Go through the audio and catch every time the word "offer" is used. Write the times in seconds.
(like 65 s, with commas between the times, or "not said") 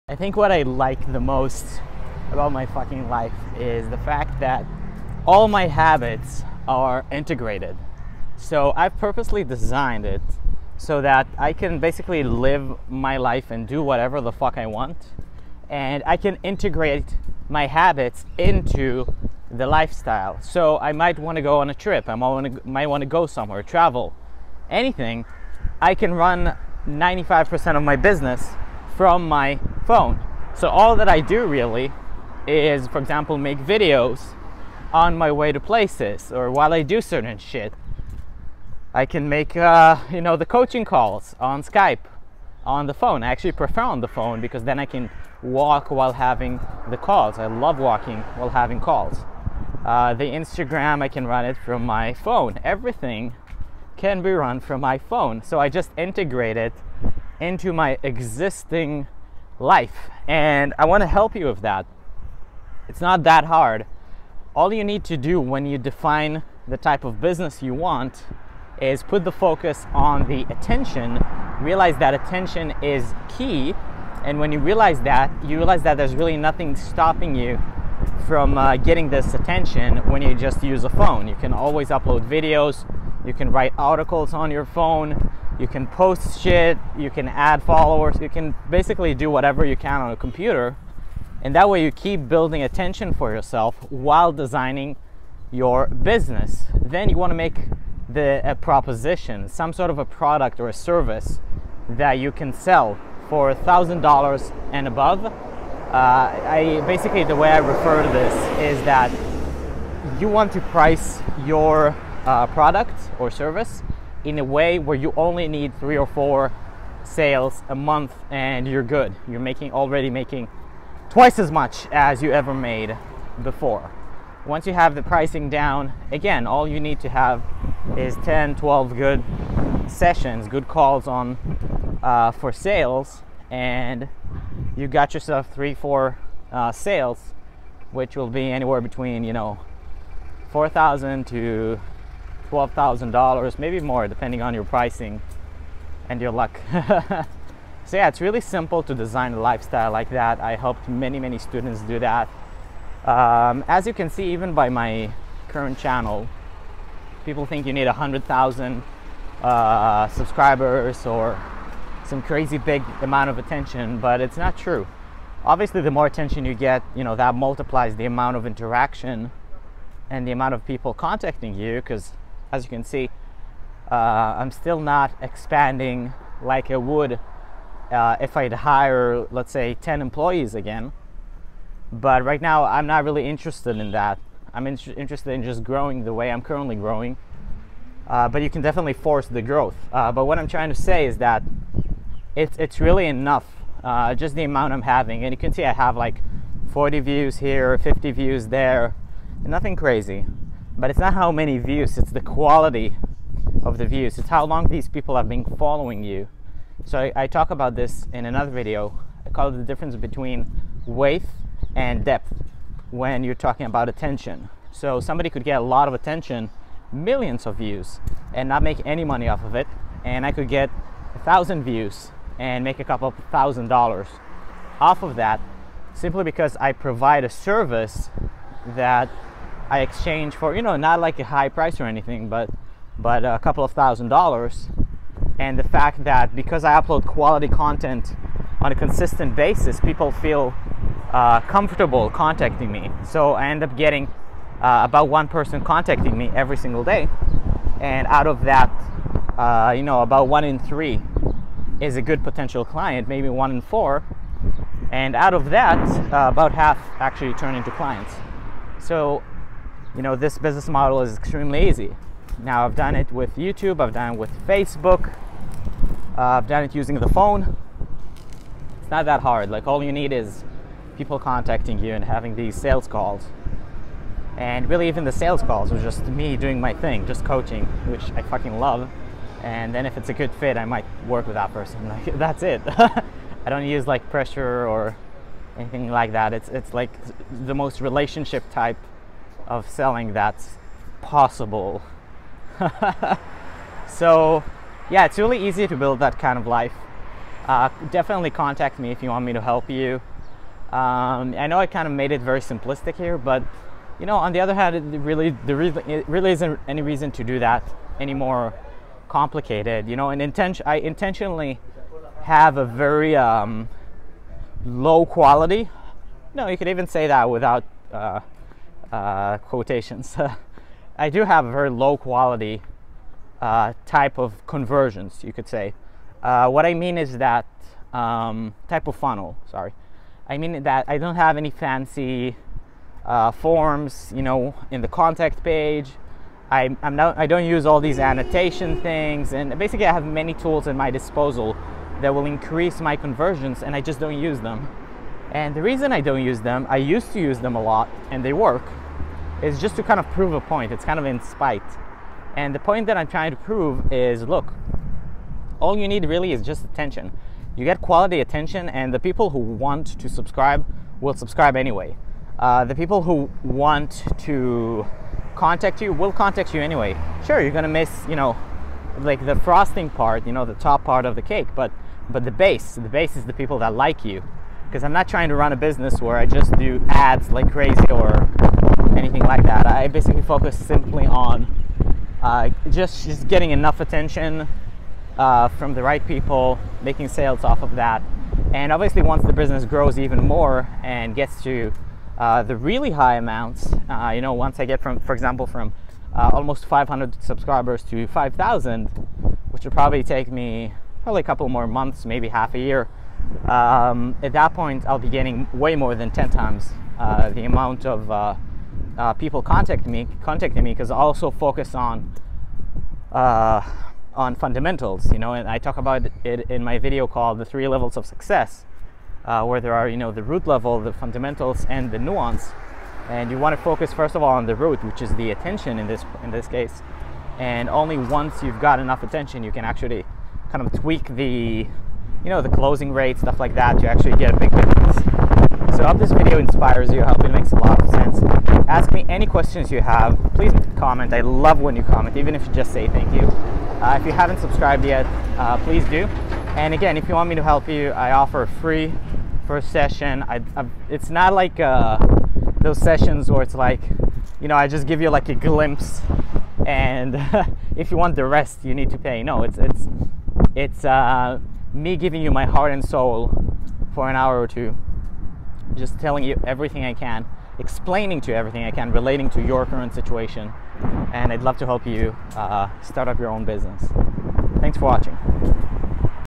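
448 s.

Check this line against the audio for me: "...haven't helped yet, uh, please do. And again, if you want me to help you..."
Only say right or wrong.
wrong.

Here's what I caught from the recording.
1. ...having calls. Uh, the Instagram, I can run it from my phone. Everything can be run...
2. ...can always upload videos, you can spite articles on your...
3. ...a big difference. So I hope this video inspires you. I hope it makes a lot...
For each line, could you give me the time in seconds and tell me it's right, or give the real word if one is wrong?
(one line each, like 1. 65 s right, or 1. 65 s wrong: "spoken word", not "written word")
1. 48 s right
2. 81 s wrong: "write", not "spite"
3. 434 s right.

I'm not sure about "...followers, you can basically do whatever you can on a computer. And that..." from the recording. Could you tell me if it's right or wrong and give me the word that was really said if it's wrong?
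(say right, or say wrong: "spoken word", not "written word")
right.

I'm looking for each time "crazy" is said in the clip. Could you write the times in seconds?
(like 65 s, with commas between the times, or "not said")
162 s, 199 s, 377 s.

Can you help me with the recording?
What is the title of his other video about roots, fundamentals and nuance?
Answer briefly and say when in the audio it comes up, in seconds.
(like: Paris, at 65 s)
The Three Levels of Success, at 417 s.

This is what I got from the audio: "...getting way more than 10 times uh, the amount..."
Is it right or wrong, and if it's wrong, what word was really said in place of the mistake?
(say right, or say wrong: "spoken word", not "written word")
right.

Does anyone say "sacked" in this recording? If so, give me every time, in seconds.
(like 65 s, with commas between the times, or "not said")
not said.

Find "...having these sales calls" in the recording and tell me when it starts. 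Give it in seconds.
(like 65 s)
272 s.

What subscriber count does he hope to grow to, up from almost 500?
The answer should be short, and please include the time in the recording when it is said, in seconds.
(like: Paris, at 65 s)
5,000, at 398 s.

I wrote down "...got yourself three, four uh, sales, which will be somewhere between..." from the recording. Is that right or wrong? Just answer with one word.
wrong.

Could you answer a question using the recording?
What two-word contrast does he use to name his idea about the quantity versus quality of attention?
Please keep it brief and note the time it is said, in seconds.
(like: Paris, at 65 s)
weight and depth, at 210 s.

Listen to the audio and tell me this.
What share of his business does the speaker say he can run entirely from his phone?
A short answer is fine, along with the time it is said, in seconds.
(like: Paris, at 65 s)
95%, at 26 s.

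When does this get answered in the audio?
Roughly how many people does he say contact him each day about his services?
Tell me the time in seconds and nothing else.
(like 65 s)
245 s.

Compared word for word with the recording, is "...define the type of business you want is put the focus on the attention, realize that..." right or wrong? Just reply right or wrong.
right.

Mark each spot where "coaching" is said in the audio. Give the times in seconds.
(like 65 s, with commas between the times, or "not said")
40 s, 277 s.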